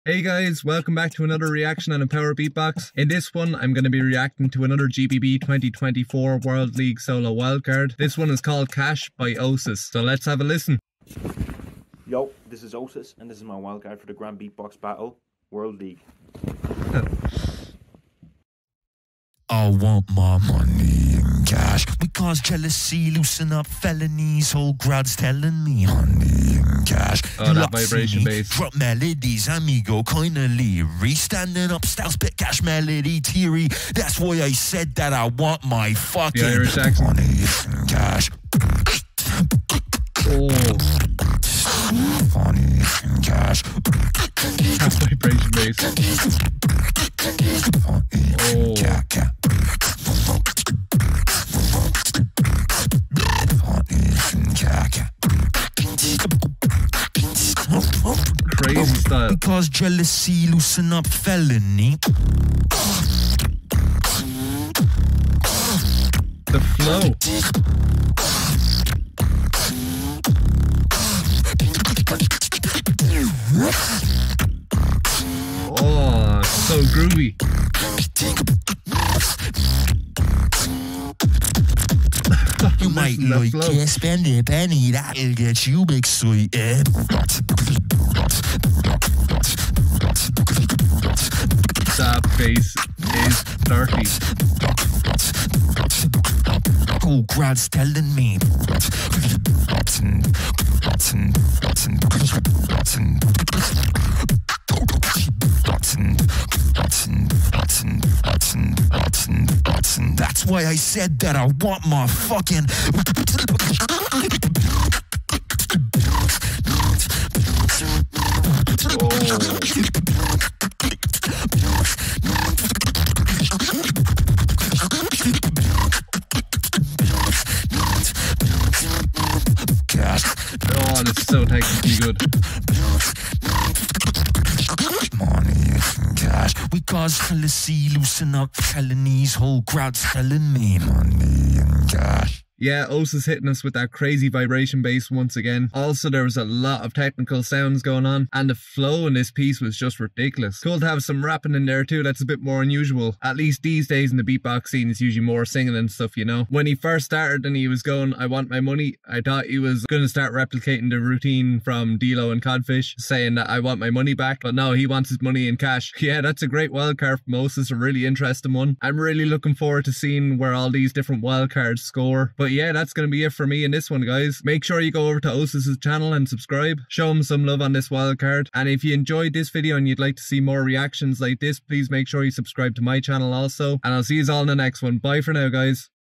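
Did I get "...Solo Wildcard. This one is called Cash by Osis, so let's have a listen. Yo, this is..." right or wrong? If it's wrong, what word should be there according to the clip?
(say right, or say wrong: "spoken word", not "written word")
right.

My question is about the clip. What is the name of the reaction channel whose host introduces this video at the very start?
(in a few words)
MpowR Beatbox.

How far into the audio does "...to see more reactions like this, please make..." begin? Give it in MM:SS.
03:00.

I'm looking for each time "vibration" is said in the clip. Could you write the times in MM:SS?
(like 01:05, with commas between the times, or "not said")
00:27, 00:45, 02:24.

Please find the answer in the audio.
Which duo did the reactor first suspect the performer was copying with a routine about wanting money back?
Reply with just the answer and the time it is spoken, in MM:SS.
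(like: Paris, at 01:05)
D-Low and Codfish, at 02:41.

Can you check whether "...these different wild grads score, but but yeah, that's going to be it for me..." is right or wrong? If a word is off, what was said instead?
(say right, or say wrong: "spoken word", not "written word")
wrong: "cards", not "grads".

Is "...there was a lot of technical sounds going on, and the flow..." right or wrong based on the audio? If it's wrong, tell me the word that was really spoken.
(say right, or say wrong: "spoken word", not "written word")
right.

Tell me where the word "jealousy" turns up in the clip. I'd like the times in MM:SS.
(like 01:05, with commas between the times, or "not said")
00:22, 00:59.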